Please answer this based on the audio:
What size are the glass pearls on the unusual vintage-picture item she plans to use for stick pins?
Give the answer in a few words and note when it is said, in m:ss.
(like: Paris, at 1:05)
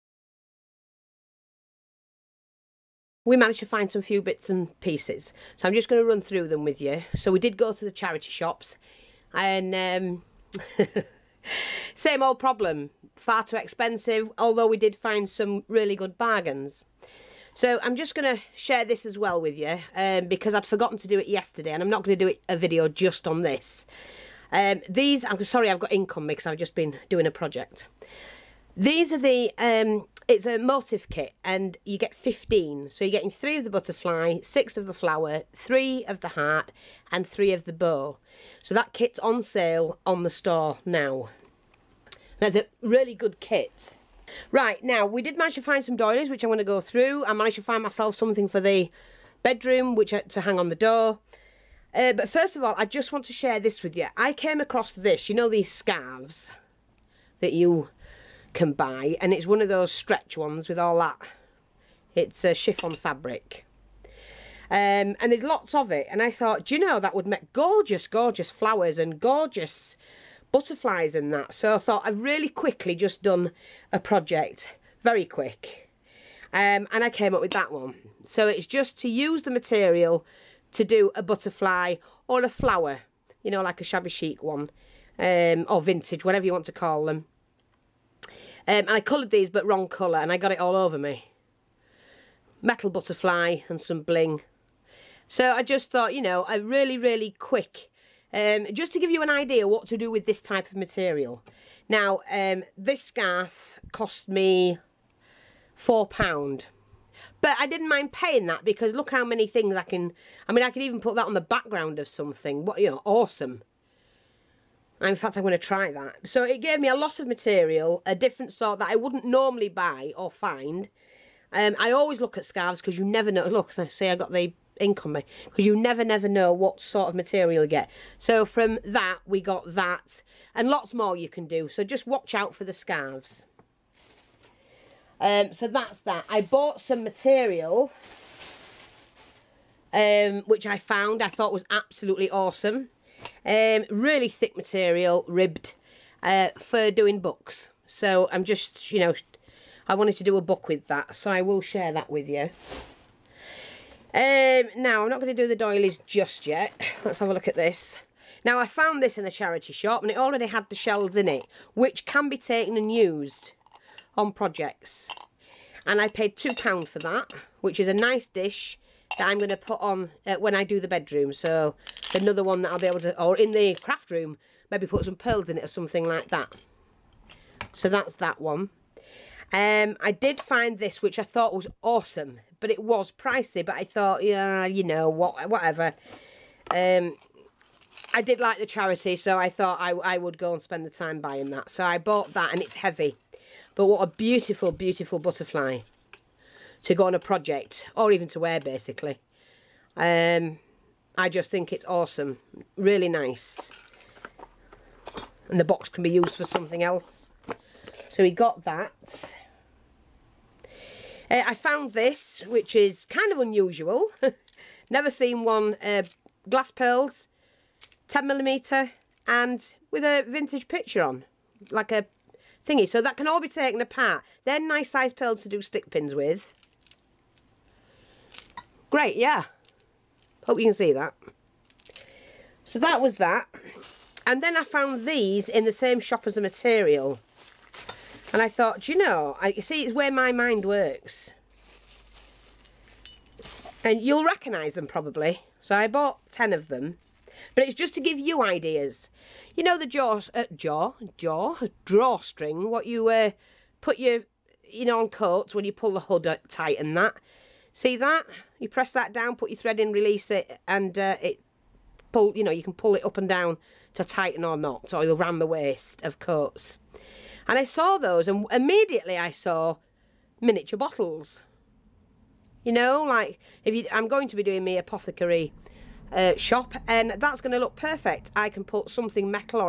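10 millimeter, at 3:38.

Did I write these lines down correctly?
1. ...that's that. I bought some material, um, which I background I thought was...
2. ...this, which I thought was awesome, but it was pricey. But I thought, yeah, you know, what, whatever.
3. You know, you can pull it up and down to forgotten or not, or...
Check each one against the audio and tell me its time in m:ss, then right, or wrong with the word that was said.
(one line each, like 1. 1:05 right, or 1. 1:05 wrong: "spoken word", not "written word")
1. 2:15 wrong: "found", not "background"
2. 3:00 right
3. 4:22 wrong: "tighten", not "forgotten".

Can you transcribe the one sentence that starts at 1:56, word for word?
So it gave me a lot of material, a different sort that I wouldn't normally buy or find.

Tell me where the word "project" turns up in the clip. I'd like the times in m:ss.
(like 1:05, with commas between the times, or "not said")
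0:27, 1:14, 2:44, 3:17.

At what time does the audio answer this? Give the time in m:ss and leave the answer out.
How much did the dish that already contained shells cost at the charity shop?
2:46.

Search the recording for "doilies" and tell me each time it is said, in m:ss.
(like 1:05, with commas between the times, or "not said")
0:45, 2:35.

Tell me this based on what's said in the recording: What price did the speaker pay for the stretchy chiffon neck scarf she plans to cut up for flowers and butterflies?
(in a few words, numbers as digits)
£4.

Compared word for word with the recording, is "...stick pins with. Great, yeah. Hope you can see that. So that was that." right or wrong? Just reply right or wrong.
right.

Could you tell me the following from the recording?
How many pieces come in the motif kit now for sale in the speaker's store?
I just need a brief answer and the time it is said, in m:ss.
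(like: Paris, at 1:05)
15, at 0:31.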